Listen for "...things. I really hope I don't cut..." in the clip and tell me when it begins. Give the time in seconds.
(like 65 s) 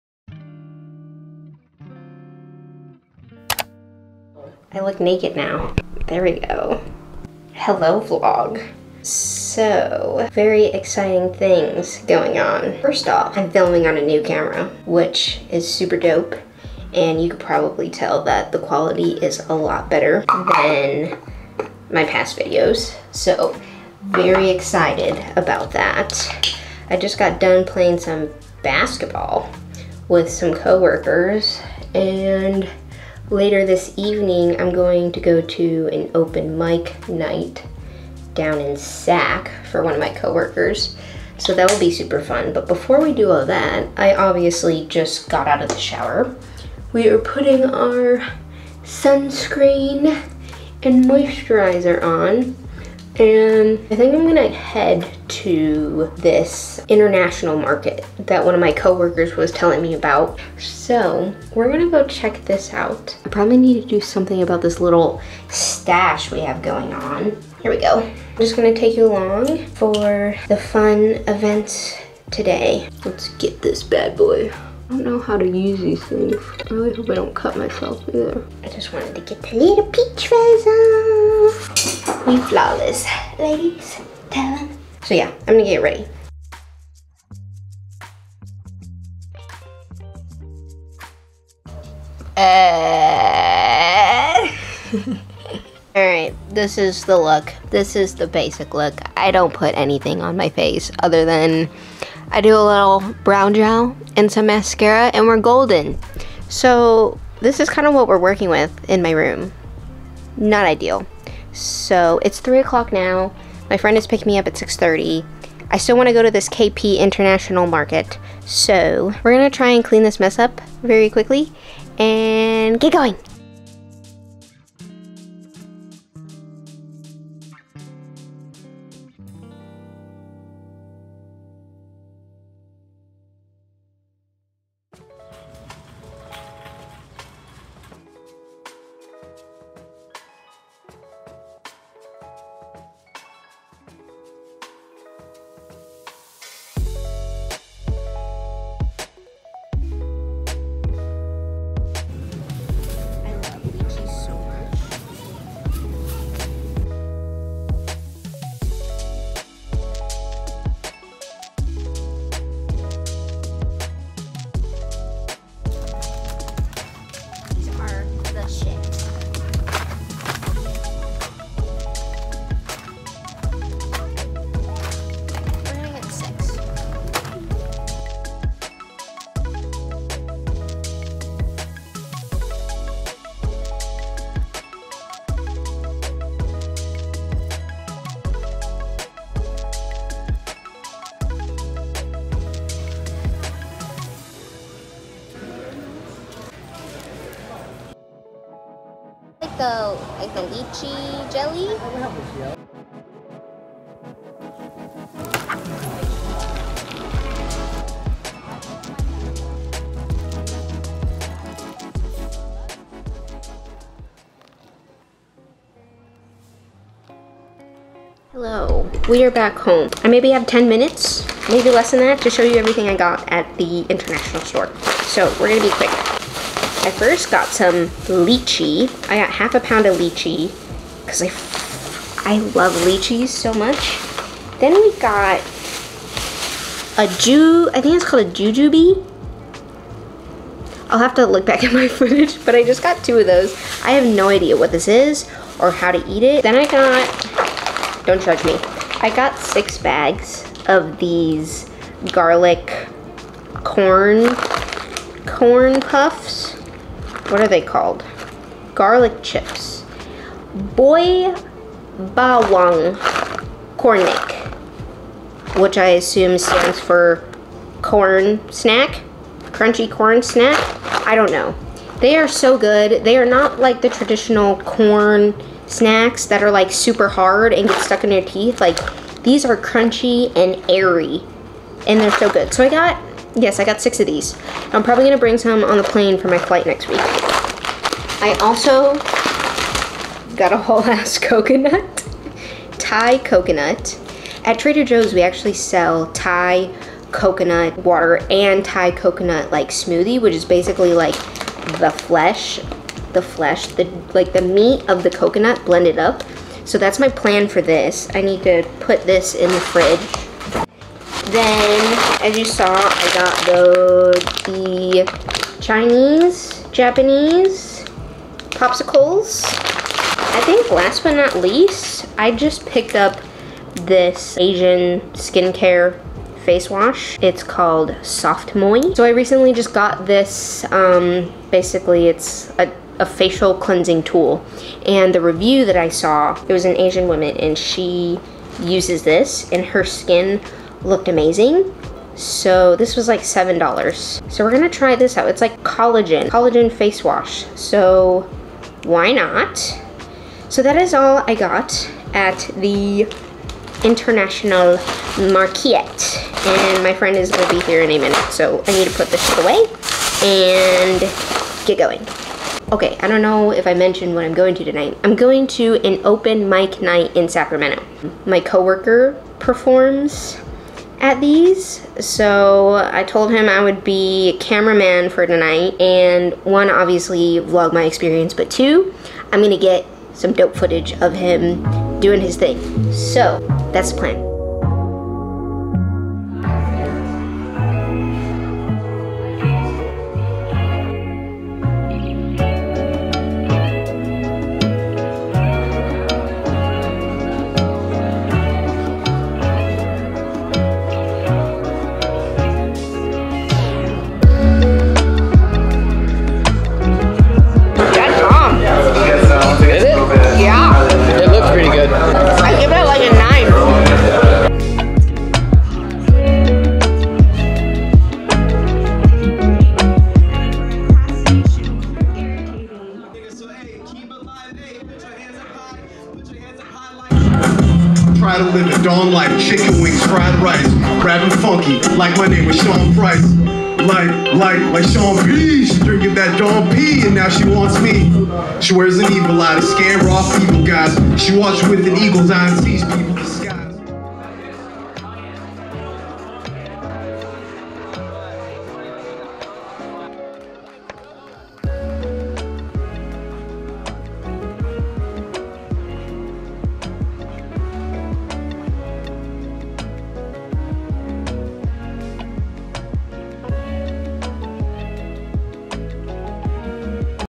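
76 s.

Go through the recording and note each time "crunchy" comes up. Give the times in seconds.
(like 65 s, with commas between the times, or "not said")
269 s, 279 s.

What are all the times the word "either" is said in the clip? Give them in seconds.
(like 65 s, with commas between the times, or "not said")
78 s.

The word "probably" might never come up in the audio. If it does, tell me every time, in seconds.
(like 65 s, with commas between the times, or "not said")
17 s, 63 s, 284 s.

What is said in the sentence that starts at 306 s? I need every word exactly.
So that's my plan for this.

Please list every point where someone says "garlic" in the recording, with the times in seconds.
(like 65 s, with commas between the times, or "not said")
252 s, 258 s.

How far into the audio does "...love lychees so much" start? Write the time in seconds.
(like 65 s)
232 s.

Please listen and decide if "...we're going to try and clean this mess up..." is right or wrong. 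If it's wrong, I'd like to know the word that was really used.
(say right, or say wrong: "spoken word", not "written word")
right.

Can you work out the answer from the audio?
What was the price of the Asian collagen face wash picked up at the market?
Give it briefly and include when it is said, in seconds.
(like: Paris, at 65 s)
$7, at 343 s.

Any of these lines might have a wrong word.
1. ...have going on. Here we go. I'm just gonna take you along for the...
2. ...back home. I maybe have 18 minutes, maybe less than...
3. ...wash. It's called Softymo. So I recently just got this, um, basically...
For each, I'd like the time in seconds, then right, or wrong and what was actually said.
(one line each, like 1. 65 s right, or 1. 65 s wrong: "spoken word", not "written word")
1. 66 s right
2. 219 s wrong: "10", not "18"
3. 326 s right.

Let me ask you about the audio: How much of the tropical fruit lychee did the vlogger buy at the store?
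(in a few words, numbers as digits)
half a pound.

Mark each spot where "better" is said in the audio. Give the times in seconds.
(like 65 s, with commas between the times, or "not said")
19 s.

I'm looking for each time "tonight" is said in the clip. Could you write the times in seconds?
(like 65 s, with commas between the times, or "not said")
364 s, 375 s.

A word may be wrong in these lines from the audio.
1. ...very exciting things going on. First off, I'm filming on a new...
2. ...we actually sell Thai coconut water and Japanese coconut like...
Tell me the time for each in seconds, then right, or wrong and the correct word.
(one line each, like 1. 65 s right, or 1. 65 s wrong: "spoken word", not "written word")
1. 10 s right
2. 295 s wrong: "Thai", not "Japanese".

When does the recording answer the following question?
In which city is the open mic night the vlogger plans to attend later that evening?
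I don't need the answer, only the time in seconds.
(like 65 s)
367 s.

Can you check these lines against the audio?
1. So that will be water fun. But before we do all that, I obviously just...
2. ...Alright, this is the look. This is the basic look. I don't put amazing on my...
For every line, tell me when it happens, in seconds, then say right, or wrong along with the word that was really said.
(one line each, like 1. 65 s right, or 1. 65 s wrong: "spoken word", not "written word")
1. 41 s wrong: "super", not "water"
2. 95 s wrong: "anything", not "amazing".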